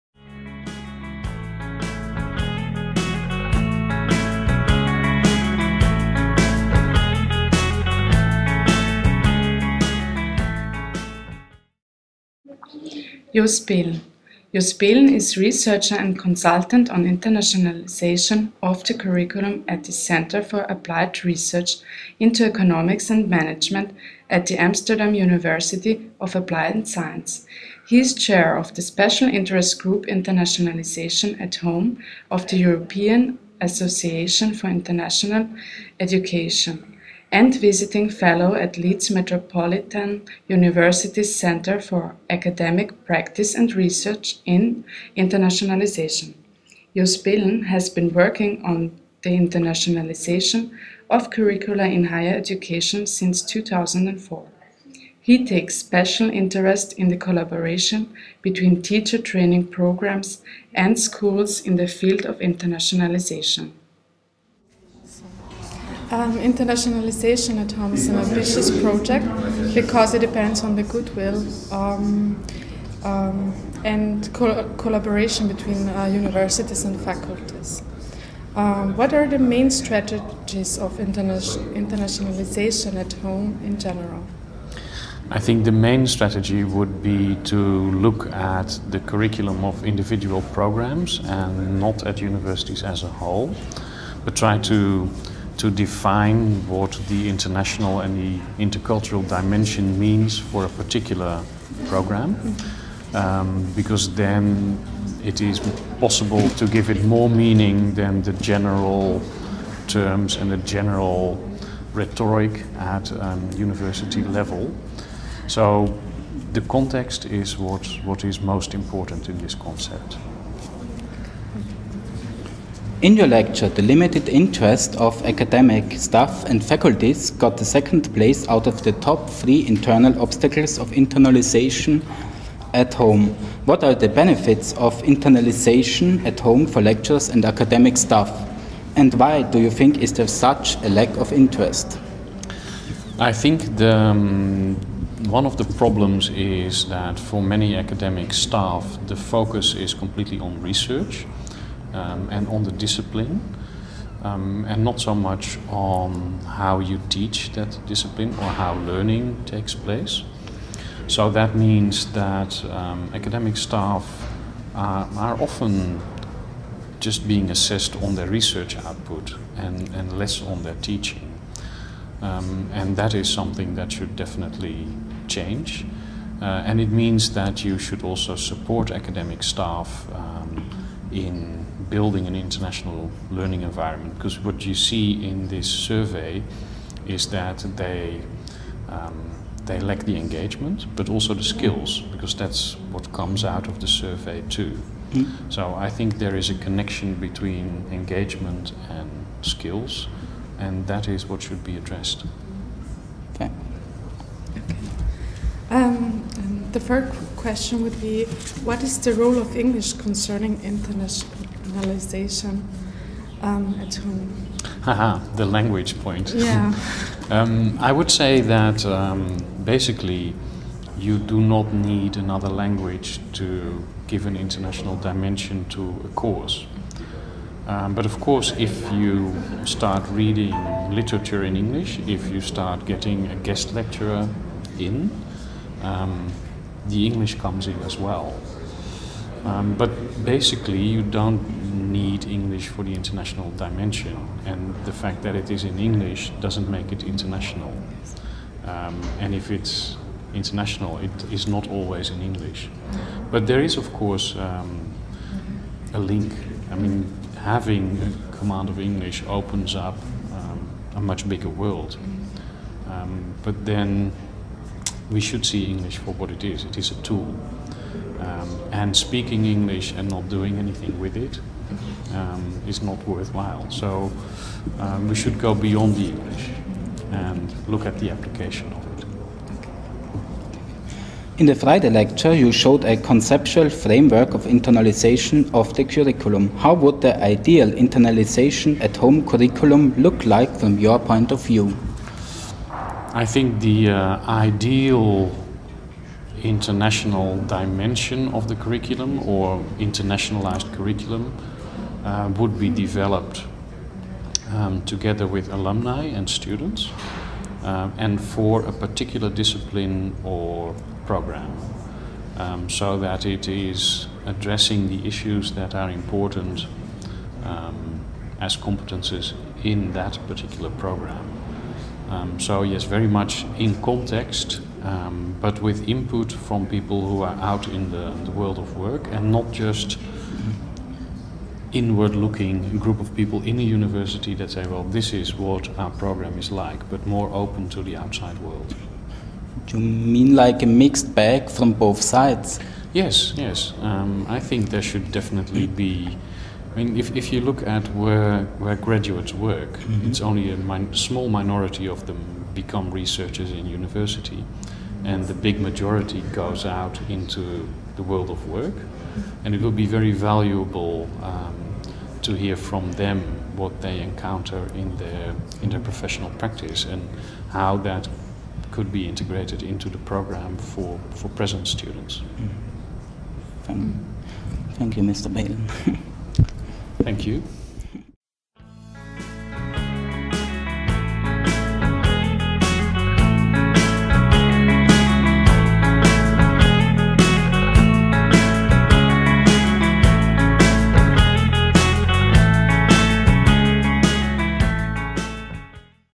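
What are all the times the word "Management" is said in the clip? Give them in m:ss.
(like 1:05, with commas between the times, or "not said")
0:23.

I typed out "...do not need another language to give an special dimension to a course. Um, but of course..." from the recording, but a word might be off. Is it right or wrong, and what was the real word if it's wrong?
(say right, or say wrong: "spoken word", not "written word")
wrong: "international", not "special".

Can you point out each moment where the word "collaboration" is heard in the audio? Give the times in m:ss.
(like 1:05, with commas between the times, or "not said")
0:57, 1:14.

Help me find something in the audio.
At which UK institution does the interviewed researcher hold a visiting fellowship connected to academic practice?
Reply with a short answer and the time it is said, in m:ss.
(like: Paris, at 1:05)
Leeds Metropolitan University, at 0:38.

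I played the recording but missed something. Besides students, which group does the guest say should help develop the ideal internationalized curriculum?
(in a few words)
alumni.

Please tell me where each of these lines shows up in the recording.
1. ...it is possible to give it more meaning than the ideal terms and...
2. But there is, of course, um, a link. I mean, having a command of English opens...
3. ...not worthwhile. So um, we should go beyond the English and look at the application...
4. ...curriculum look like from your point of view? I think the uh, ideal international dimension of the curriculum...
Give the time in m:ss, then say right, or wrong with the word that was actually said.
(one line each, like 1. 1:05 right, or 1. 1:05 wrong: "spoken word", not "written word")
1. 1:45 wrong: "general", not "ideal"
2. 4:13 right
3. 4:32 right
4. 4:49 right.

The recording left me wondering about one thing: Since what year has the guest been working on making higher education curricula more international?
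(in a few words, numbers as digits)
2004.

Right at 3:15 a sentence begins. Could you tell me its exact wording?
so I think there is a connection between engagement and skills and that is what should be addressed okay, okay.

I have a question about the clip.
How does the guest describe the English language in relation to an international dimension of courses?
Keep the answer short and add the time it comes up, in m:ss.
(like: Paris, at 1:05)
a tool, at 4:26.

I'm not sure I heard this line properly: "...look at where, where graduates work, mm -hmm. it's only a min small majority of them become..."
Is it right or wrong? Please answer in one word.
wrong.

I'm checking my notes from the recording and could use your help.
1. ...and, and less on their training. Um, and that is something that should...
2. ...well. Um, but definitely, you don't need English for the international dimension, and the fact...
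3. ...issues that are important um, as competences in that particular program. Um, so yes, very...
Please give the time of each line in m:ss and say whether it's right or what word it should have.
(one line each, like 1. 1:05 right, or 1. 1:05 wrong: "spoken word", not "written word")
1. 2:49 wrong: "teaching", not "training"
2. 3:57 wrong: "basically", not "definitely"
3. 5:15 right.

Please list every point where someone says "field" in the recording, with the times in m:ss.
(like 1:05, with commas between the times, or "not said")
1:01.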